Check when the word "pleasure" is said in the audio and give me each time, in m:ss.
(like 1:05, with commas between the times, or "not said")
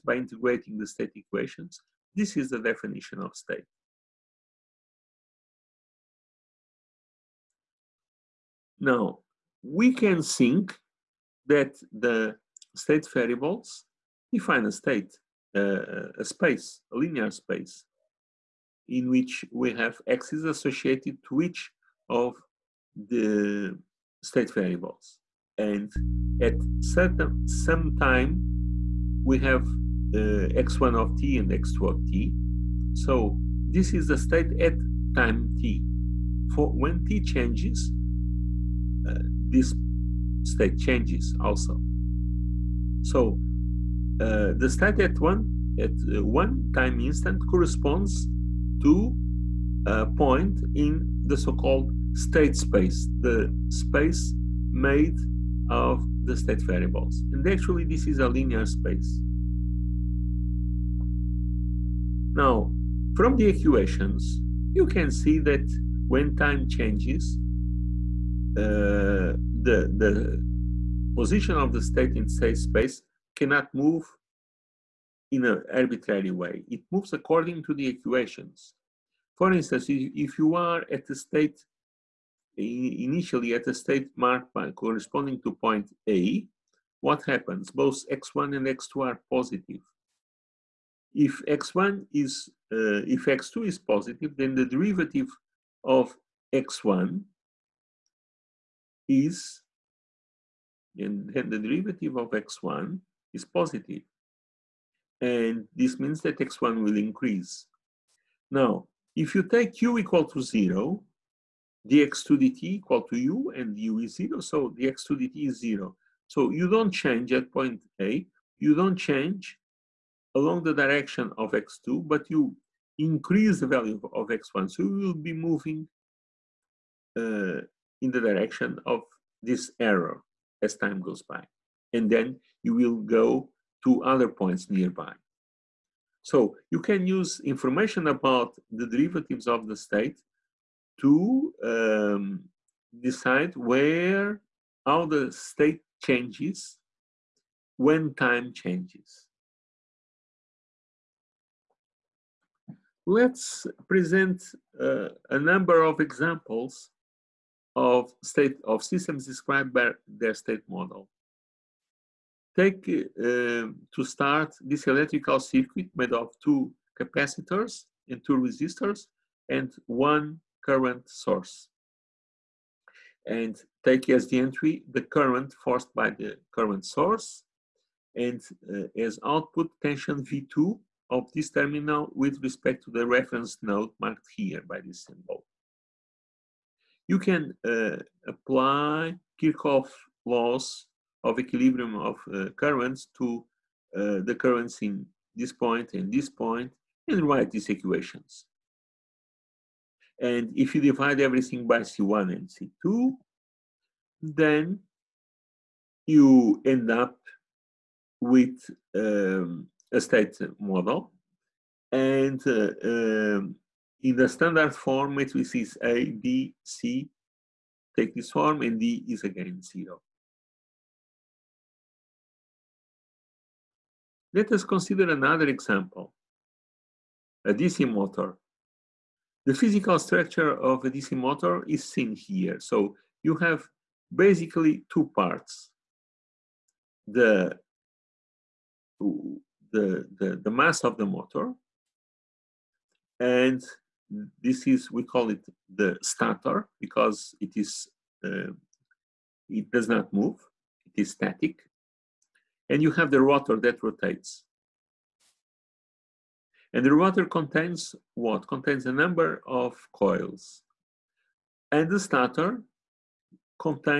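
not said.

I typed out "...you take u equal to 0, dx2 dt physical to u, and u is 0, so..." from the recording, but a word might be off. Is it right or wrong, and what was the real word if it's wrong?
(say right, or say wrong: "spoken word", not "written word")
wrong: "equal", not "physical".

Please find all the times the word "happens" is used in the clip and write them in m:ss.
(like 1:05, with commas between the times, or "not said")
1:27.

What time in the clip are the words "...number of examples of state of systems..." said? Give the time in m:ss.
2:35.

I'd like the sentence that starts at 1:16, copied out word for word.
It moves according to the equations.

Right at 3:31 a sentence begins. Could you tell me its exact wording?
And uh, um, in the standard form, matrix is A, B, C, take this form, and D is again zero.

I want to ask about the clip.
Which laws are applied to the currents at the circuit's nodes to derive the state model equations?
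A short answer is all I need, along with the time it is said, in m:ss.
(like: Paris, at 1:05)
Kirchhoff laws, at 3:09.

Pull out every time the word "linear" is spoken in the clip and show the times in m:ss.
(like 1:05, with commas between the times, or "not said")
0:16, 0:58.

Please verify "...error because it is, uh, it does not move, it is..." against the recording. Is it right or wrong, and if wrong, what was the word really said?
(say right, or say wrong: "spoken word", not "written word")
wrong: "stator", not "error".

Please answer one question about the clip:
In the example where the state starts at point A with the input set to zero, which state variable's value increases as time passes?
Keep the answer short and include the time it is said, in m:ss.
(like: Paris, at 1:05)
x1, at 2:02.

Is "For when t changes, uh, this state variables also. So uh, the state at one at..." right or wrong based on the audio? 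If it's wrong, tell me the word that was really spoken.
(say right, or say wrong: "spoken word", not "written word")
wrong: "changes", not "variables".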